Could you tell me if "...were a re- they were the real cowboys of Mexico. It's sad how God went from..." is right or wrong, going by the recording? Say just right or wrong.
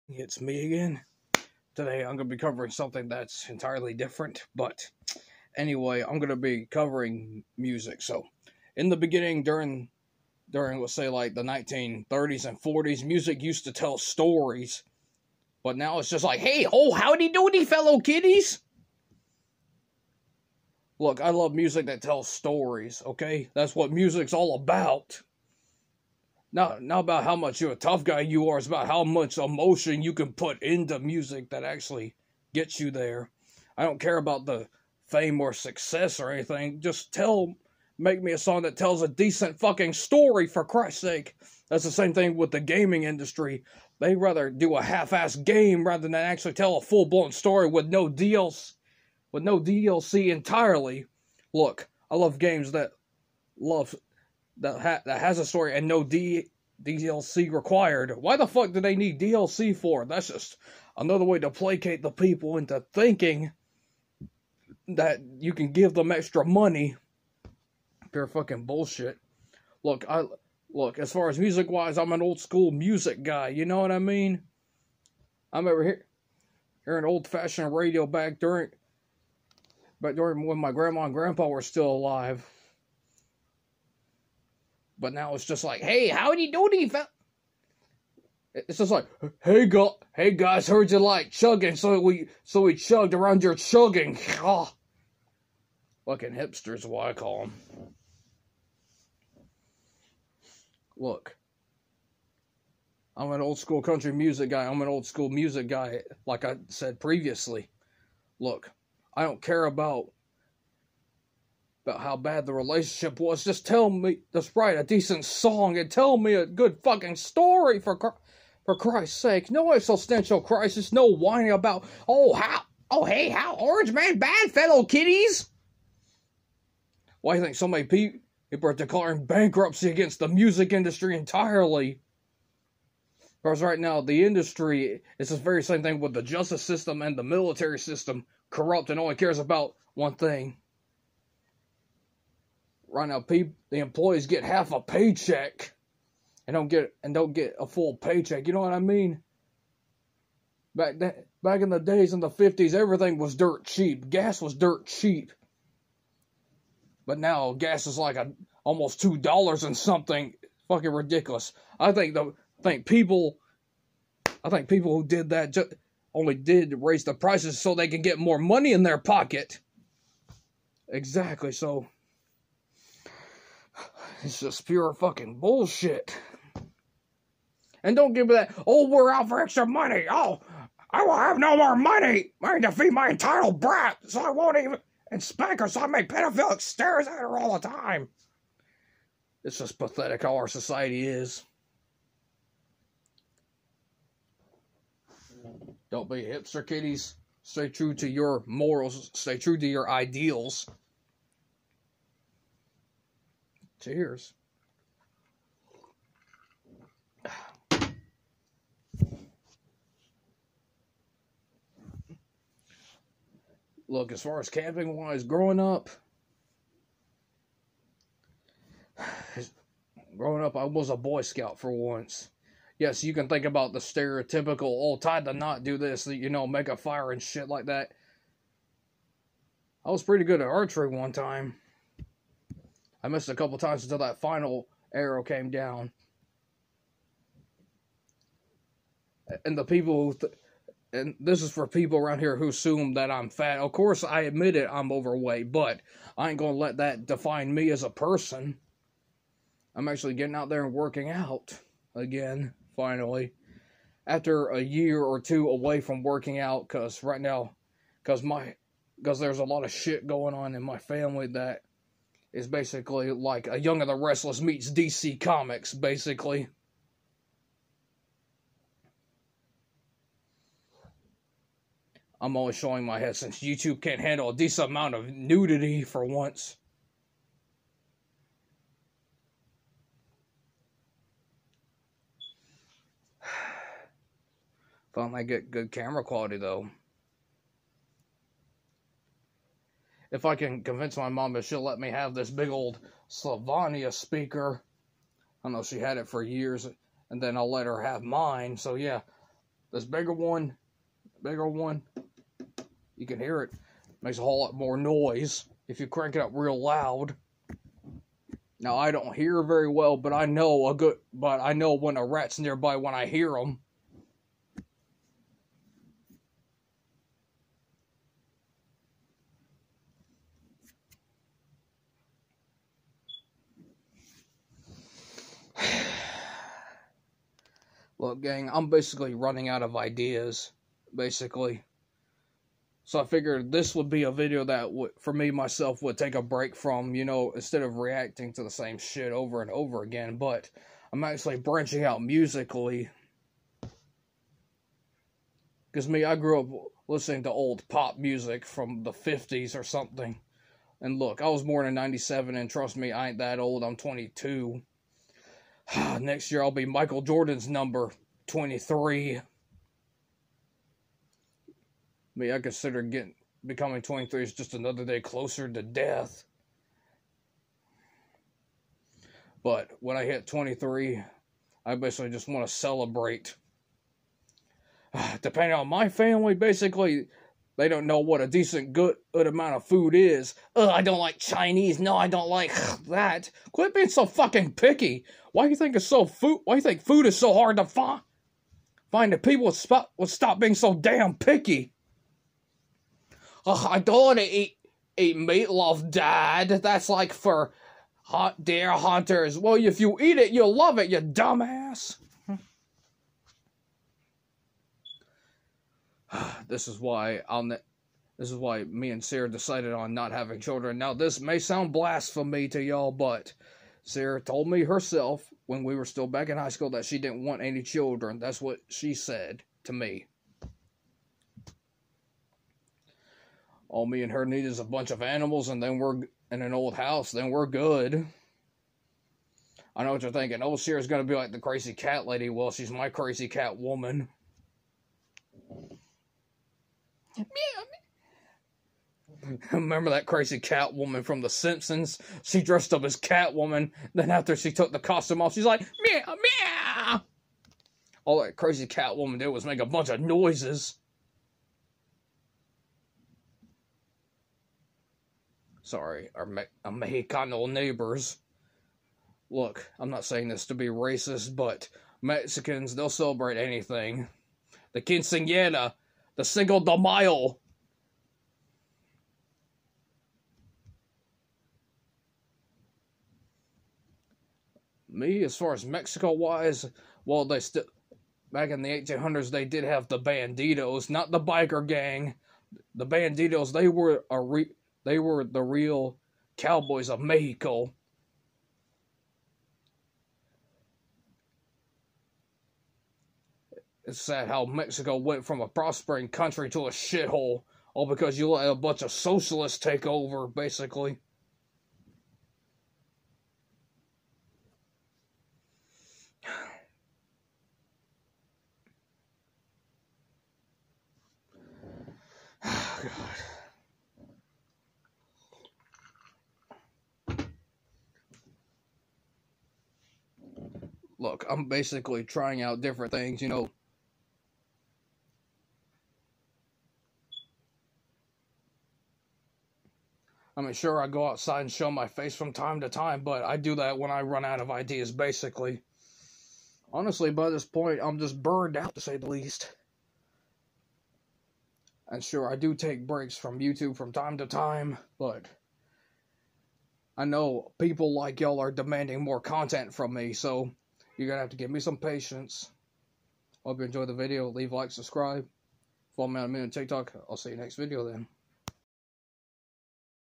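wrong.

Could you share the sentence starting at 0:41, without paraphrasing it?
That's the same thing with the gaming industry.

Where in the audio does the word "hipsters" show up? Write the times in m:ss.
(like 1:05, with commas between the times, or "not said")
1:36, 3:16.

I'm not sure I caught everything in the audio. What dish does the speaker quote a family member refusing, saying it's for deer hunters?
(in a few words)
meatloaf.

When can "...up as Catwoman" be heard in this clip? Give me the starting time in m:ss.
7:22.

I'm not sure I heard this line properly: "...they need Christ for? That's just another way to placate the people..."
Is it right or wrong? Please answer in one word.
wrong.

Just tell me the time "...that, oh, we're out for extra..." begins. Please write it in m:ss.
2:58.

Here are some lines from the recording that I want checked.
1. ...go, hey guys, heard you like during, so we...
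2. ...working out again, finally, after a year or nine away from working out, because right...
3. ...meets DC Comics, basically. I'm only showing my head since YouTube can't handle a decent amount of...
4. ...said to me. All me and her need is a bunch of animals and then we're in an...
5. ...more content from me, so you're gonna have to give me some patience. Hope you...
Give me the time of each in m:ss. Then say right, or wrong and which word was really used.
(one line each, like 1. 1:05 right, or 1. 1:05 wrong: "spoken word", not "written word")
1. 1:29 wrong: "chugging", not "during"
2. 4:10 wrong: "two", not "nine"
3. 4:24 right
4. 6:58 right
5. 9:09 right.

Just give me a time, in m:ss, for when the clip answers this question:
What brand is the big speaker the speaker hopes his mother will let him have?
4:53.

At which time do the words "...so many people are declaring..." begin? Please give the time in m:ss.
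2:07.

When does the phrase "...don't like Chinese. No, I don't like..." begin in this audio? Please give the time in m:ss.
6:20.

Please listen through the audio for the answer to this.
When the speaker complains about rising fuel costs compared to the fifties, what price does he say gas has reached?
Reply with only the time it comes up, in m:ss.
2:38.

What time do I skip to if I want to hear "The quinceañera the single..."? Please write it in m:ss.
7:44.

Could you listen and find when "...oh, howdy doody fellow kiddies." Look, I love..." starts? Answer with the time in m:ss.
0:16.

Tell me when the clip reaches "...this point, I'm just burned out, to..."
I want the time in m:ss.
8:57.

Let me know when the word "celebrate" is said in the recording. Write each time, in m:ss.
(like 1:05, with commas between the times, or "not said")
6:12, 7:42.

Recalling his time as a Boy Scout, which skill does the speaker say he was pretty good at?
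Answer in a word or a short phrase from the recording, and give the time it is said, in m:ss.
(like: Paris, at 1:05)
archery, at 3:50.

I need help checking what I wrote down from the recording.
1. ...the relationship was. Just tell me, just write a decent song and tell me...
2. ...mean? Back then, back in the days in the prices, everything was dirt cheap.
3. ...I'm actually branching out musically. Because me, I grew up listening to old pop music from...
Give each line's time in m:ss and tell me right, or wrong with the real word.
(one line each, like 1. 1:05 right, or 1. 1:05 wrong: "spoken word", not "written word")
1. 1:52 right
2. 2:28 wrong: "fifties", not "prices"
3. 5:40 right.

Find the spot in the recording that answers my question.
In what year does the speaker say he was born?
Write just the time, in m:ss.
5:51.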